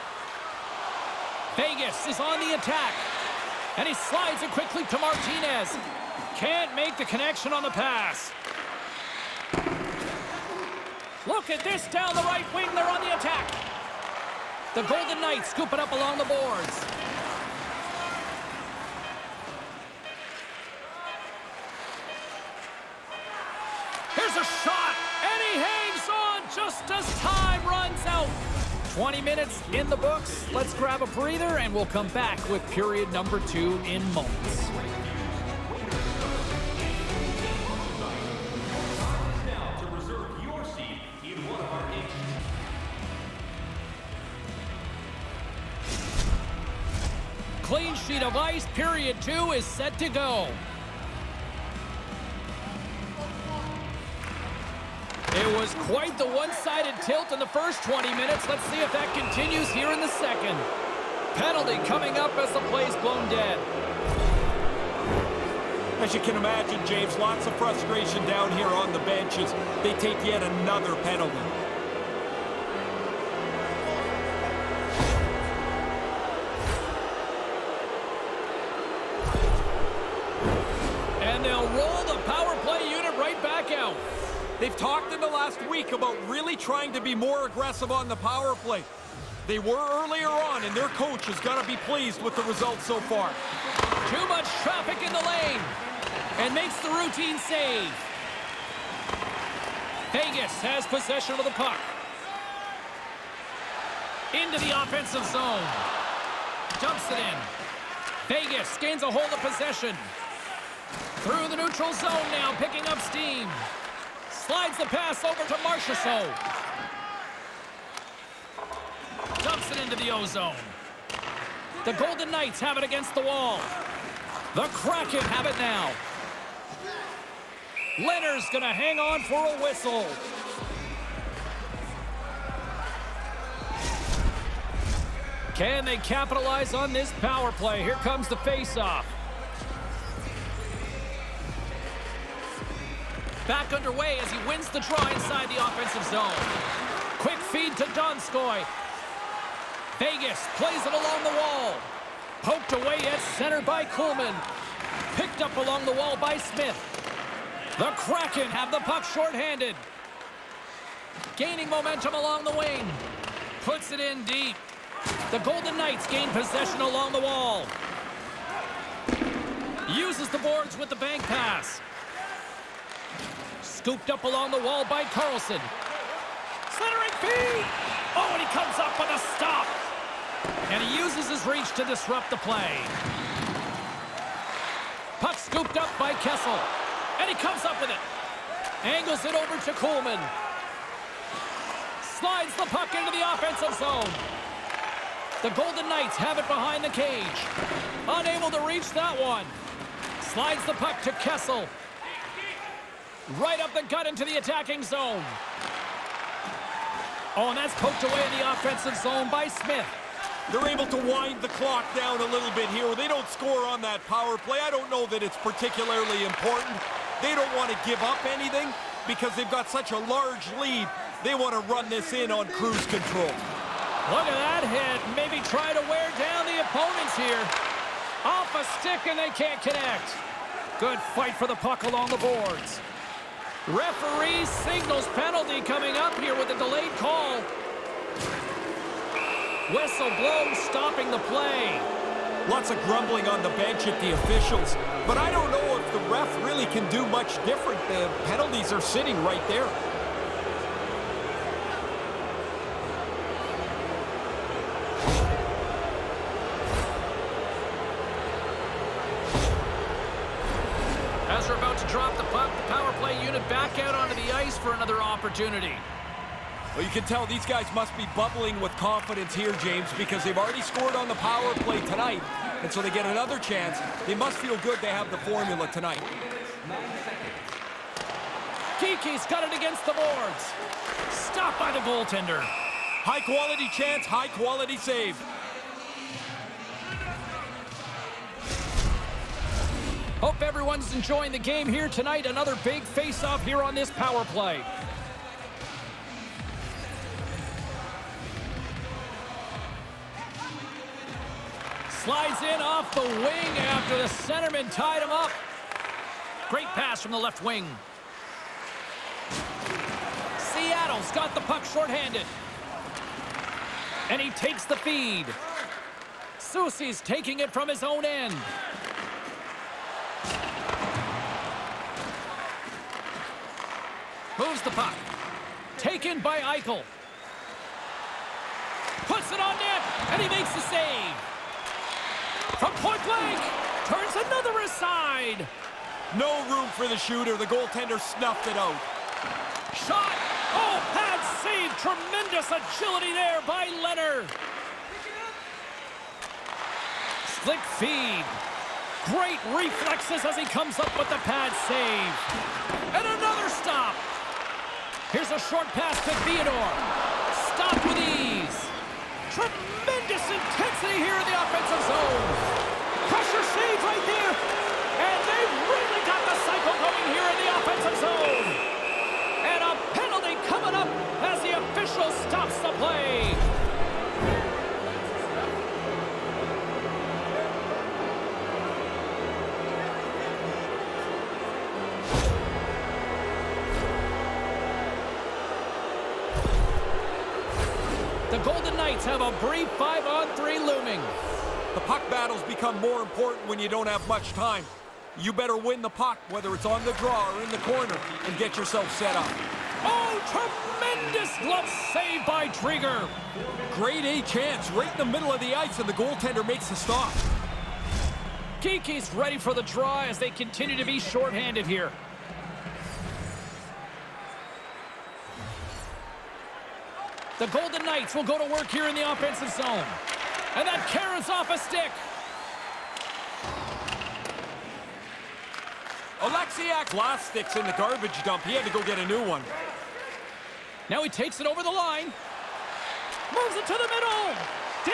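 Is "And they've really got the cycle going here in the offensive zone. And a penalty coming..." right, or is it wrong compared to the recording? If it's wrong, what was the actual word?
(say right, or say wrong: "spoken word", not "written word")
right.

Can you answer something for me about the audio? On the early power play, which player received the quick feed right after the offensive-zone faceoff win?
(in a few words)
Donskoy.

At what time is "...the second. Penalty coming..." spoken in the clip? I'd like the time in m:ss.
0:59.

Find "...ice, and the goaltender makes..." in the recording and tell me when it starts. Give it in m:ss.
6:45.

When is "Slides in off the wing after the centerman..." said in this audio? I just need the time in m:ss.
5:01.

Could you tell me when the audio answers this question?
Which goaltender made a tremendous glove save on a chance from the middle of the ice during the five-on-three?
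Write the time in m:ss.
6:42.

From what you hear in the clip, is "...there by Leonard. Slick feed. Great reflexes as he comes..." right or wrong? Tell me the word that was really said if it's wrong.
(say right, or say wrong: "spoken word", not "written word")
right.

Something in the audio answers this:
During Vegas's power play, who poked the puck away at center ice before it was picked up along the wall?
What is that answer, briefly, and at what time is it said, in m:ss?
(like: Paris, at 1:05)
Coolman, at 2:33.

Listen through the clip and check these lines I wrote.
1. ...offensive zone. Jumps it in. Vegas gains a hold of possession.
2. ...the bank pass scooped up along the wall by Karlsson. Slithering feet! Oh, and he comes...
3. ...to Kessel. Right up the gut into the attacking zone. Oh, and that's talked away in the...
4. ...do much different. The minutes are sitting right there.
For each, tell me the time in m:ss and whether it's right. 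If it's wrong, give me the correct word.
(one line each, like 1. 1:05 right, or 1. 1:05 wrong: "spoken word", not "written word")
1. 1:44 right
2. 2:50 right
3. 3:21 wrong: "poked", not "talked"
4. 4:06 wrong: "penalties", not "minutes".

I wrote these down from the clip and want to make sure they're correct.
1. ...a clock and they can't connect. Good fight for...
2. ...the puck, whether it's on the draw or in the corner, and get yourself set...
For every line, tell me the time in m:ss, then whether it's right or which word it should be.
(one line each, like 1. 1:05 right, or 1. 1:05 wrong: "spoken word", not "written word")
1. 3:48 wrong: "stick", not "clock"
2. 6:35 right.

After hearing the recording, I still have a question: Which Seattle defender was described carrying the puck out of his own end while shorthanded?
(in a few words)
Soucy.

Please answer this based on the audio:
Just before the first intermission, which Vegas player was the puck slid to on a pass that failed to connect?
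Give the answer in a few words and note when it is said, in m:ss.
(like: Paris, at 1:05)
Martinez, at 0:04.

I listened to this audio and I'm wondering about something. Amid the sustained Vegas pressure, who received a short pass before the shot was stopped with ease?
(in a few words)
Theodore.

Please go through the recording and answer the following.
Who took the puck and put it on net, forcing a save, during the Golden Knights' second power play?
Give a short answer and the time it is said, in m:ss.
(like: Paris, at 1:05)
Eichel, at 5:26.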